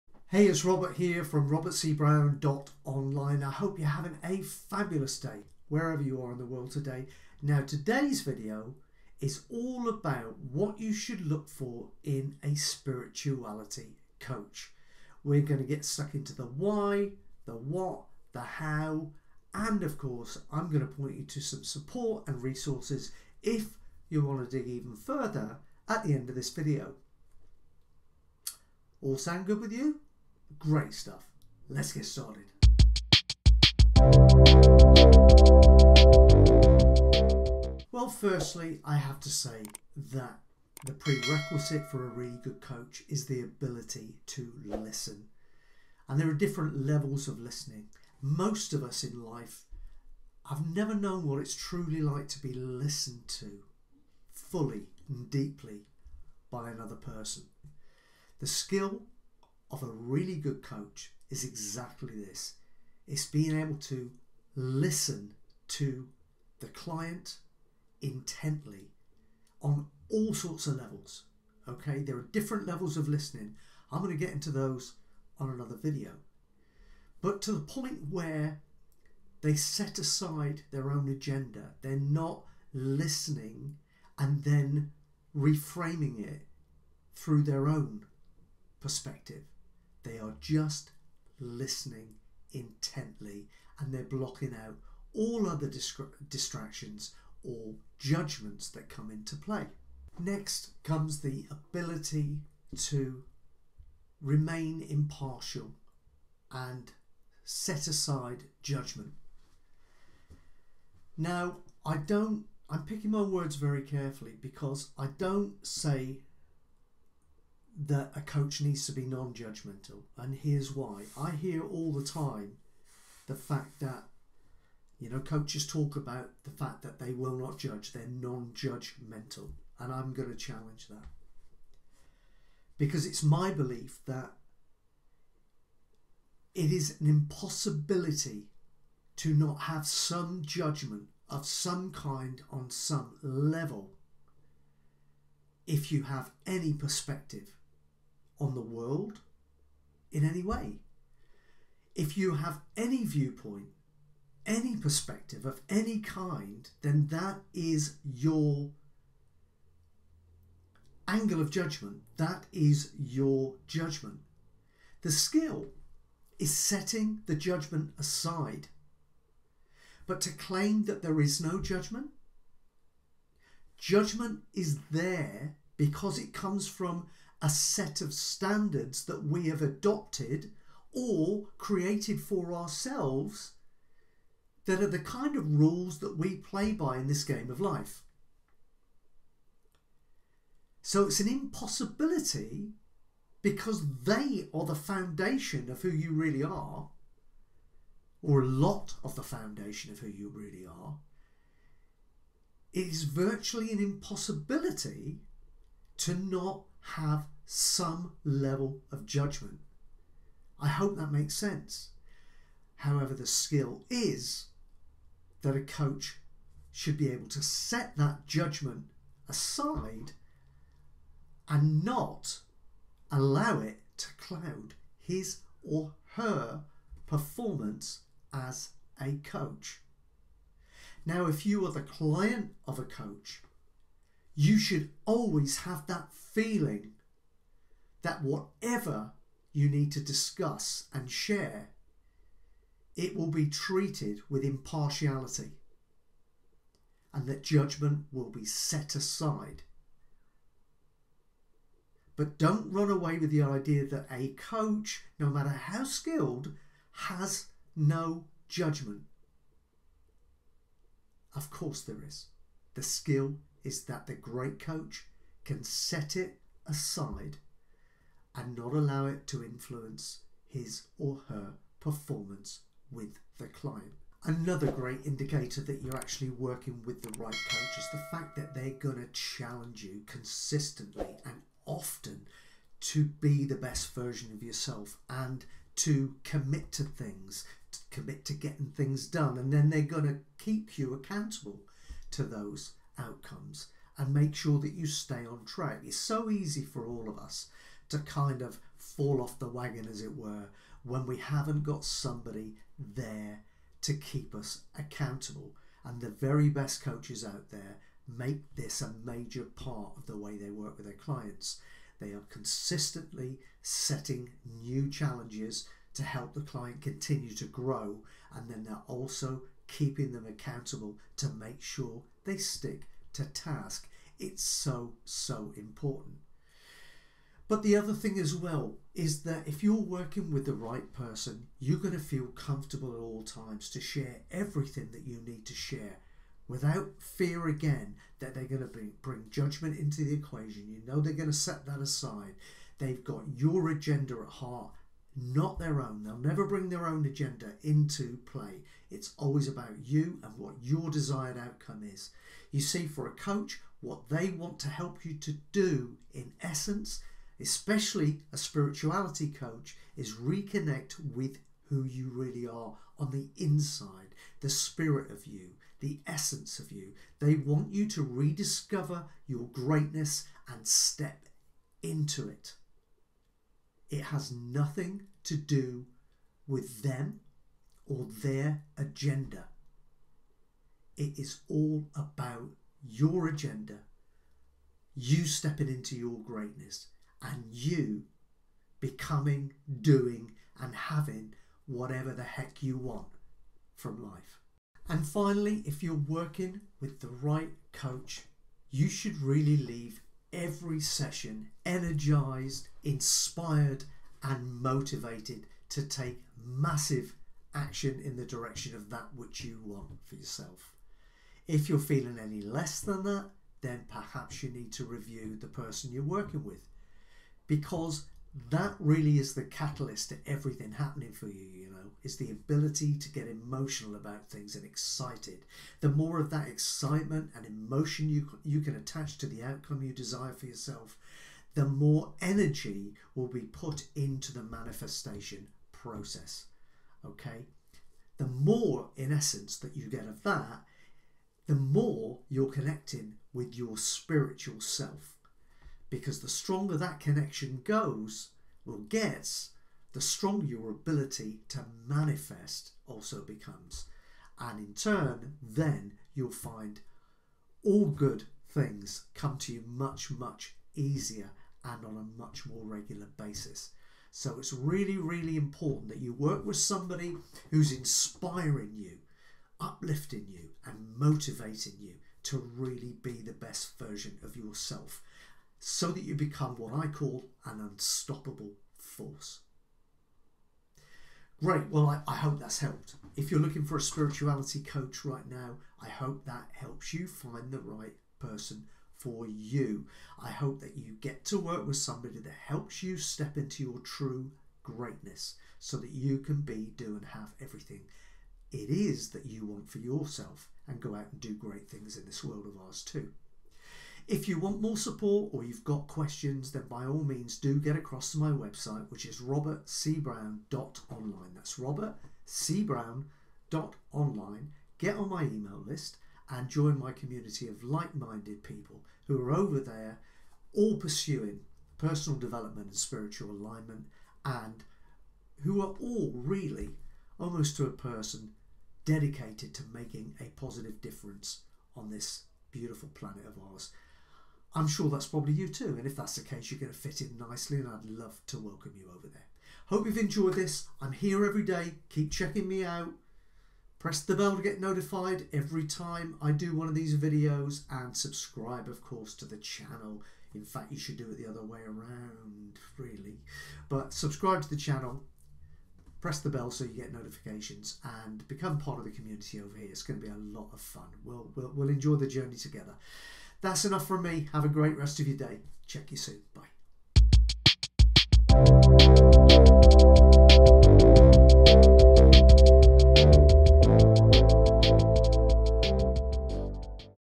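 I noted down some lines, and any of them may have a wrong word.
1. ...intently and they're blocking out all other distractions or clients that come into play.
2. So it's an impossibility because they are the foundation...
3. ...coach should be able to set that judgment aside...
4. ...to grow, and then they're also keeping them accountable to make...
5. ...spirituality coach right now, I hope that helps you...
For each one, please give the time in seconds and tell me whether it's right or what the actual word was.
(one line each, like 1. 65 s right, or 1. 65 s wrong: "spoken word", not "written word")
1. 92 s wrong: "judgments", not "clients"
2. 190 s right
3. 215 s right
4. 317 s right
5. 483 s right.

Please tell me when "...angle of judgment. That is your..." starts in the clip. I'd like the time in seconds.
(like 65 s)
161 s.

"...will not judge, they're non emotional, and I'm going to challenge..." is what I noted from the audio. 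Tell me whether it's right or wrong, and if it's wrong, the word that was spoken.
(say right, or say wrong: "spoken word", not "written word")
wrong: "judgmental", not "emotional".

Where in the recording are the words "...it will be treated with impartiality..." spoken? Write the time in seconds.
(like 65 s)
242 s.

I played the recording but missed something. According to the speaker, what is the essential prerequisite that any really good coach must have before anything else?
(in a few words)
The ability to listen.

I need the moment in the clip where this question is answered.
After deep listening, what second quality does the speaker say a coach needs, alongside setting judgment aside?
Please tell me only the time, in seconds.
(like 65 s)
104 s.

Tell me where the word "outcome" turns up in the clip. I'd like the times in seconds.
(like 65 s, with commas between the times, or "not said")
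293 s, 351 s, 429 s.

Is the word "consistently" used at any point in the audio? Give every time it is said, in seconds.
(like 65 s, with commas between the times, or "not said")
280 s, 312 s.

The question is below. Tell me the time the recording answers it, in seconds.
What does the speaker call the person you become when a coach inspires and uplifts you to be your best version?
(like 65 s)
477 s.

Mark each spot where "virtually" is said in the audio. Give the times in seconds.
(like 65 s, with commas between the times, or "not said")
203 s.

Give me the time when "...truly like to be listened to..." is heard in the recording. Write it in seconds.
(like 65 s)
51 s.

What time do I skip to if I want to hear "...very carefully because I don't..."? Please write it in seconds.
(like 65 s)
113 s.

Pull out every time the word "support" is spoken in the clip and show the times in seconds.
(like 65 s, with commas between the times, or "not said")
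21 s, 504 s.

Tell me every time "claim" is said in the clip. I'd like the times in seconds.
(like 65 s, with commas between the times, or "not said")
170 s.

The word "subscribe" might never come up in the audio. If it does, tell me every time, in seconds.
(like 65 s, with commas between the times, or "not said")
547 s, 553 s.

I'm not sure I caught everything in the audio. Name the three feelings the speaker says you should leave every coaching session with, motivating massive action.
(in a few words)
Energized, inspired, and motivated.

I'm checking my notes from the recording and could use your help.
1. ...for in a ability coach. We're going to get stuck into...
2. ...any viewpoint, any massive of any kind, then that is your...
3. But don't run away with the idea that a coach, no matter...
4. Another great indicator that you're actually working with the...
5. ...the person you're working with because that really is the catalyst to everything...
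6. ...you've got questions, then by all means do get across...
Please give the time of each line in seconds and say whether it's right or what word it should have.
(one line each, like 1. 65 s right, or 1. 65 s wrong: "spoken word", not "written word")
1. 11 s wrong: "spirituality", not "ability"
2. 152 s wrong: "perspective", not "massive"
3. 252 s right
4. 274 s right
5. 415 s right
6. 505 s right.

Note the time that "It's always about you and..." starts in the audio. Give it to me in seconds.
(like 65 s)
348 s.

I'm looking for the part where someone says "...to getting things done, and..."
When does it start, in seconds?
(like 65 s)
288 s.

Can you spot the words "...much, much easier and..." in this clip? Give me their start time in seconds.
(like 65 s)
459 s.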